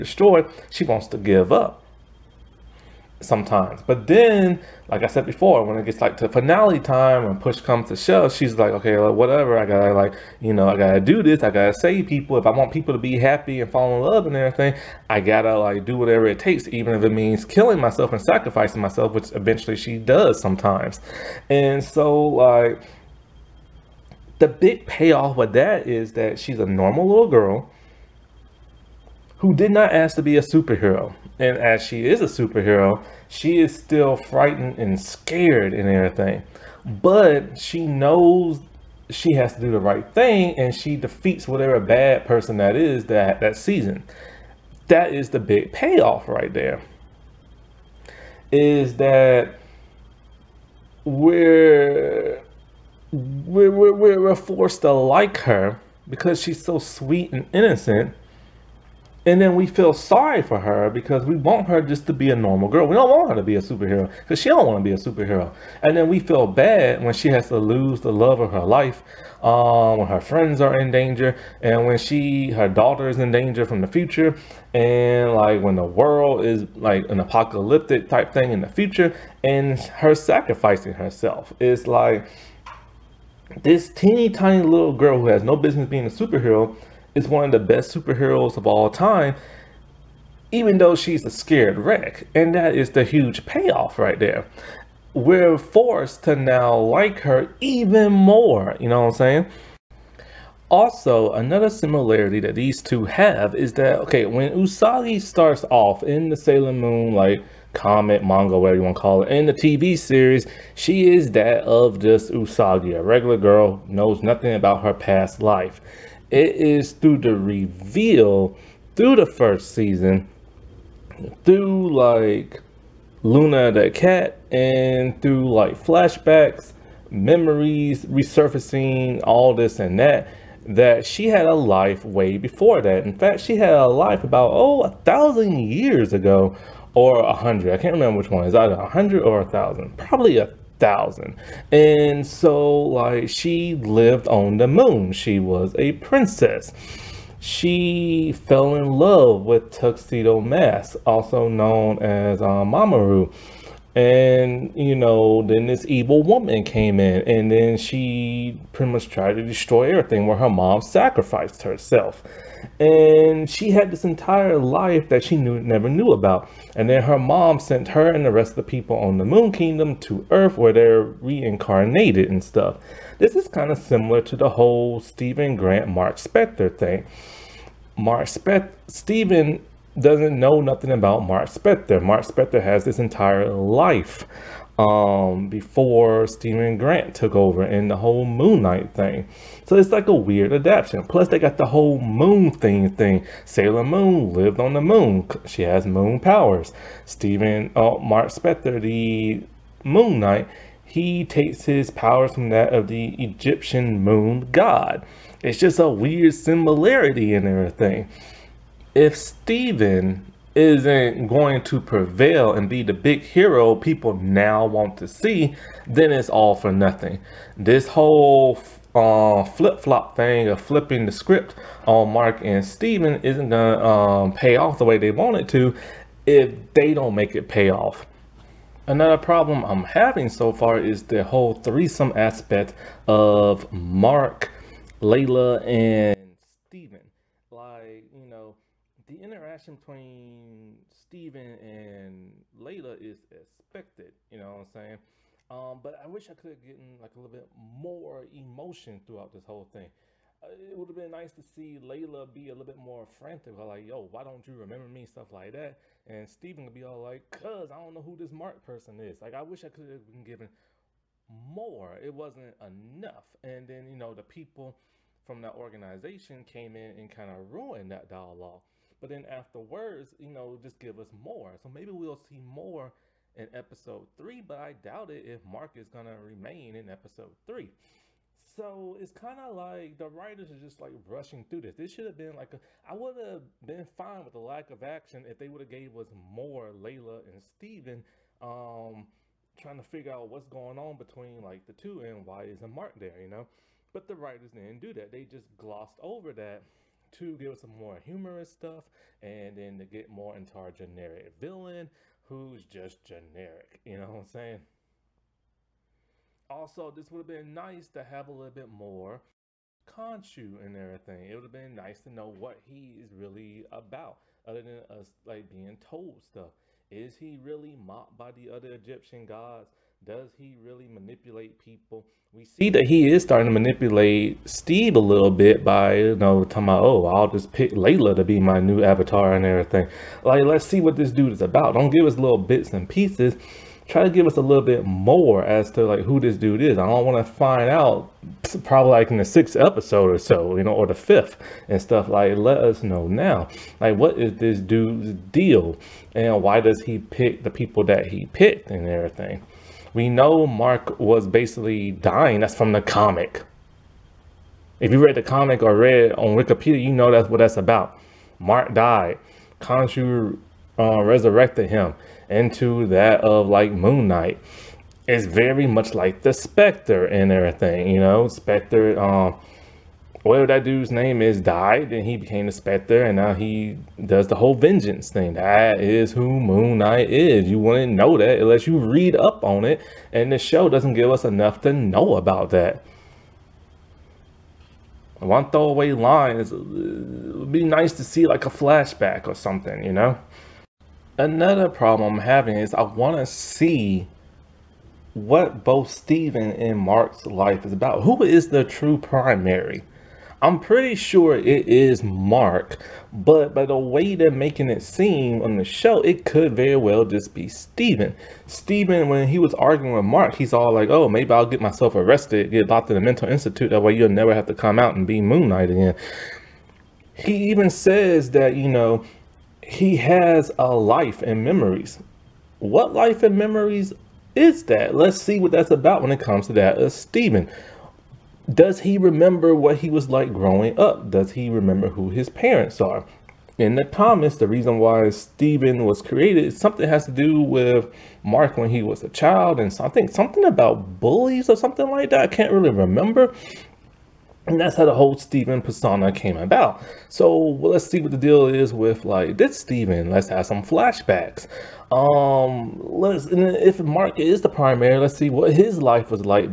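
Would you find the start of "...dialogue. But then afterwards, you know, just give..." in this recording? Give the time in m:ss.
4:28.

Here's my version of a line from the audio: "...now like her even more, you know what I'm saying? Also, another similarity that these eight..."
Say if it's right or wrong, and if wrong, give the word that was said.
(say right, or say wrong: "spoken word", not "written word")
wrong: "two", not "eight".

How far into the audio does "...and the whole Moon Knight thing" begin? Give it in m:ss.
3:07.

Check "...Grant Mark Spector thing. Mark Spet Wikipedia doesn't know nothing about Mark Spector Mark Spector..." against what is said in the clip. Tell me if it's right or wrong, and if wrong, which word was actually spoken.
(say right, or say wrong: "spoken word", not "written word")
wrong: "Steven", not "Wikipedia".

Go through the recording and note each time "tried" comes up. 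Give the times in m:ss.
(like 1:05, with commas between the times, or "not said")
2:39.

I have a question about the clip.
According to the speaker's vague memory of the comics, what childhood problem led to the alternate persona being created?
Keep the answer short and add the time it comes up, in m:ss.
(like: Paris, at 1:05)
bullies, at 7:21.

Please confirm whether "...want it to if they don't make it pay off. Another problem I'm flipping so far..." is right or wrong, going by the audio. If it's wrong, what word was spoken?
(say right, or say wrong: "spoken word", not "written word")
wrong: "having", not "flipping".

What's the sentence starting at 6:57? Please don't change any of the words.
He even says that, you know, he has a life and memories.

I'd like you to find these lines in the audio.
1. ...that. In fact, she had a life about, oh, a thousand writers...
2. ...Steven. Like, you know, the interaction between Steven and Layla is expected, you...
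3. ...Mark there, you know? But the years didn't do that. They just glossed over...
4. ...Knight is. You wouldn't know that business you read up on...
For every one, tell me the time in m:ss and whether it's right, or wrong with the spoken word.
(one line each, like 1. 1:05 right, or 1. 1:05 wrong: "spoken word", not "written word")
1. 2:12 wrong: "years", not "writers"
2. 3:56 right
3. 4:52 wrong: "writers", not "years"
4. 6:16 wrong: "unless", not "business".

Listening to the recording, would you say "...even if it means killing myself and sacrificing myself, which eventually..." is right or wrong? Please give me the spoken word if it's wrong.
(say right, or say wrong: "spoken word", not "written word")
right.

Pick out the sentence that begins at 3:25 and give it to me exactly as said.
It's just a weird similarity in everything.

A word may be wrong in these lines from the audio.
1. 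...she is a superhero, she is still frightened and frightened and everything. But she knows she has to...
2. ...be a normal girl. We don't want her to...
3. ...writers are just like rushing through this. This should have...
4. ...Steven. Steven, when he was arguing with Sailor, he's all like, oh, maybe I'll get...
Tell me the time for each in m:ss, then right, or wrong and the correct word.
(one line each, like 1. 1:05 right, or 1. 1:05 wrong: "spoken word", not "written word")
1. 0:31 wrong: "scared", not "frightened"
2. 1:02 right
3. 4:40 right
4. 6:47 wrong: "Mark", not "Sailor".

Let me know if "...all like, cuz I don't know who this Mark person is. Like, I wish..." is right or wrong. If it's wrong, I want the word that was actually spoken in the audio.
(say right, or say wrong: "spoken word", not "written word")
right.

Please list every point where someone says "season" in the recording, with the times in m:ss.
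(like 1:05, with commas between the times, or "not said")
0:43, 1:59.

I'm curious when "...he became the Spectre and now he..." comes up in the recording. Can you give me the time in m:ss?
6:12.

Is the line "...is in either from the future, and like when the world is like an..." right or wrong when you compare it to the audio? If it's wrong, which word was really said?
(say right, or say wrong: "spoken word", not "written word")
wrong: "danger", not "either".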